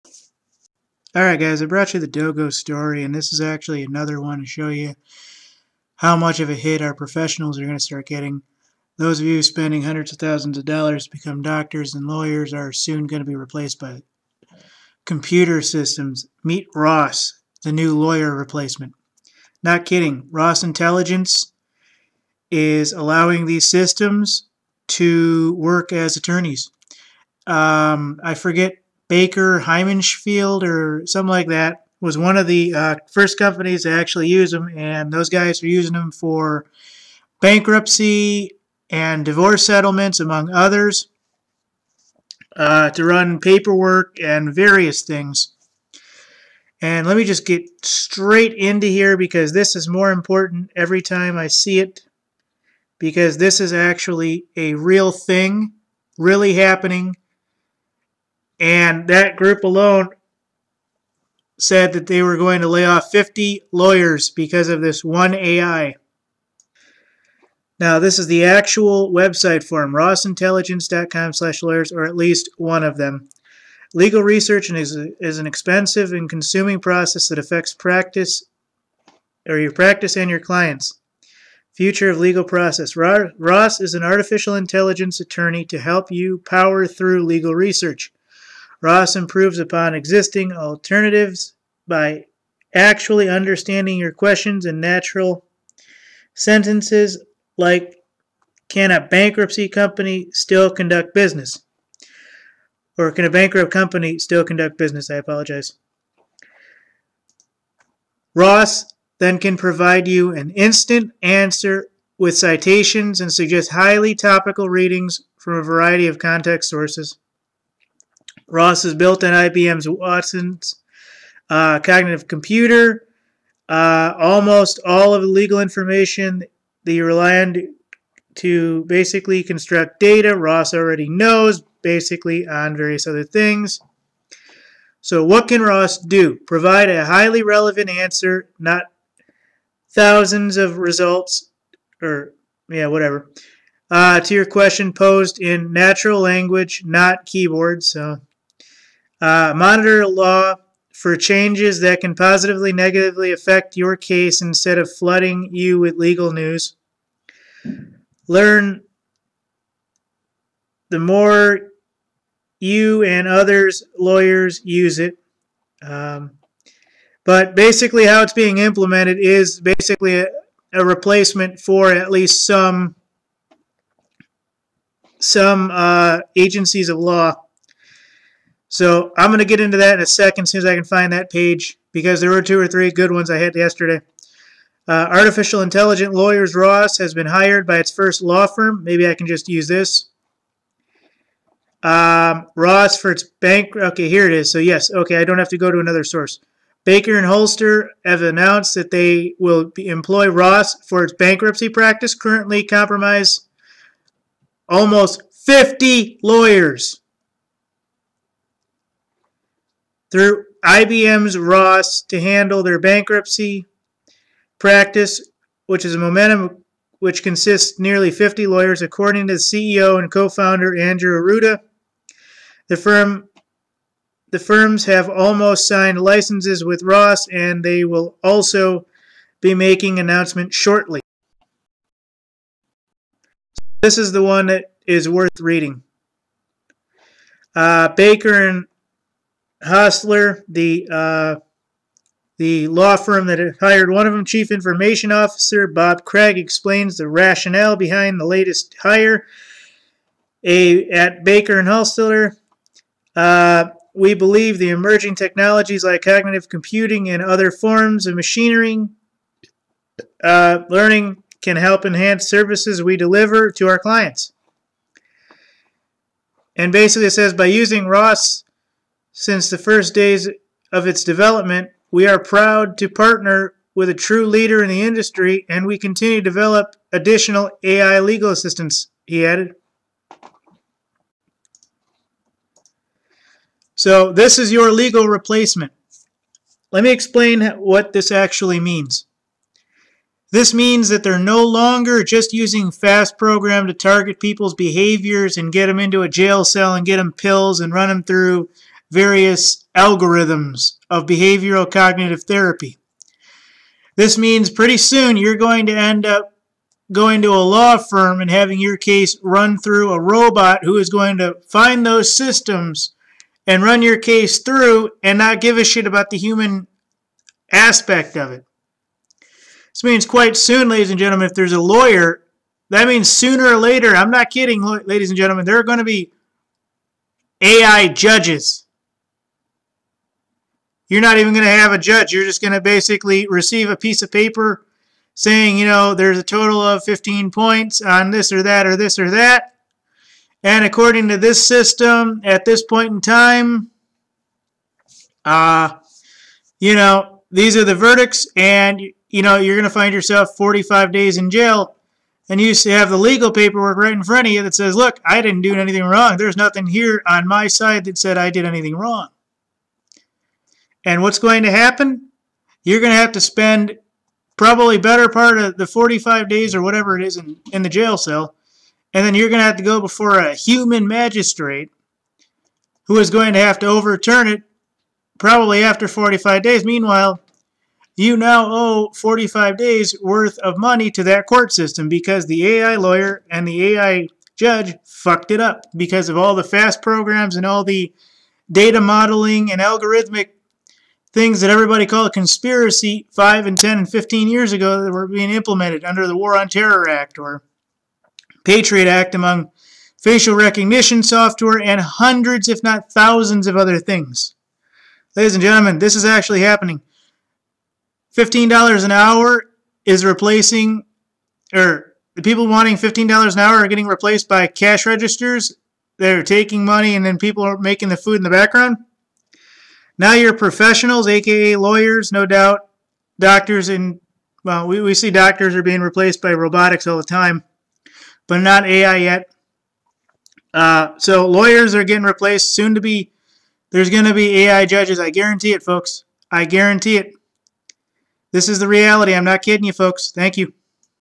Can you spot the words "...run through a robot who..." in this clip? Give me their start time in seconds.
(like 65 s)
309 s.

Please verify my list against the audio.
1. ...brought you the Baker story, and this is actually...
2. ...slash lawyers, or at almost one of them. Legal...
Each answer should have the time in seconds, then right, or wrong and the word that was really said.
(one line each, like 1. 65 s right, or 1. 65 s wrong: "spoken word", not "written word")
1. 1 s wrong: "Dogo", not "Baker"
2. 71 s wrong: "least", not "almost".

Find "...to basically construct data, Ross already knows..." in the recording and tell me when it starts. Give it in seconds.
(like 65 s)
128 s.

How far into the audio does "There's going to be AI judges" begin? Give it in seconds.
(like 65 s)
433 s.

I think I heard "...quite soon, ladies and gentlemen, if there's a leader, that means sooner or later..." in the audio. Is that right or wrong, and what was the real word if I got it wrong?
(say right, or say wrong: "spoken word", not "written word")
wrong: "lawyer", not "leader".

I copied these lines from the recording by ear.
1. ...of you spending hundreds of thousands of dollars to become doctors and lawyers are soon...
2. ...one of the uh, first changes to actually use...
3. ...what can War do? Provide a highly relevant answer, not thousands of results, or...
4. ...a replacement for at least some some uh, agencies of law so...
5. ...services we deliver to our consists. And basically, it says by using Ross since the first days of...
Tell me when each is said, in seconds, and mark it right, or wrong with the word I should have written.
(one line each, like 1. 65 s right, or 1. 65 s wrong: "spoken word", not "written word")
1. 9 s right
2. 32 s wrong: "companies", not "changes"
3. 135 s wrong: "Ross", not "War"
4. 170 s right
5. 262 s wrong: "clients", not "consists".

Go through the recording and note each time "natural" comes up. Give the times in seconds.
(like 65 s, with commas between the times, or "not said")
94 s, 145 s.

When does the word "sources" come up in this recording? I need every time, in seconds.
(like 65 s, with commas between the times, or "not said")
116 s, 196 s.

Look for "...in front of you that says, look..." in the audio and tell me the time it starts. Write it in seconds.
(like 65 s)
353 s.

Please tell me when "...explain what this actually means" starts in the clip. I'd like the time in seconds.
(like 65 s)
286 s.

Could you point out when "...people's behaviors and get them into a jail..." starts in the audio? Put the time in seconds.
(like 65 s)
294 s.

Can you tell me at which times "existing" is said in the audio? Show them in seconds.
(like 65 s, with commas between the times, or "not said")
89 s.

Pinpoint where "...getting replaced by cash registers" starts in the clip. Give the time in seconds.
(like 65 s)
413 s.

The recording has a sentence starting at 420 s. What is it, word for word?
Now you're professionals, aka lawyers, no doubt.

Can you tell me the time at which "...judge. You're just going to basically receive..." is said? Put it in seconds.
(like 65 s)
331 s.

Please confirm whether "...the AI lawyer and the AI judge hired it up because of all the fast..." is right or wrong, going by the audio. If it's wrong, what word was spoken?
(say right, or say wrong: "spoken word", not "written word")
wrong: "fucked", not "hired".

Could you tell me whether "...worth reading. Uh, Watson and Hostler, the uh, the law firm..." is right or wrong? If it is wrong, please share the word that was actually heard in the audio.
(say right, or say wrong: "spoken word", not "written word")
wrong: "Baker", not "Watson".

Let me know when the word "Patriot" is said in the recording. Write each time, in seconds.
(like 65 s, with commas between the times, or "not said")
398 s.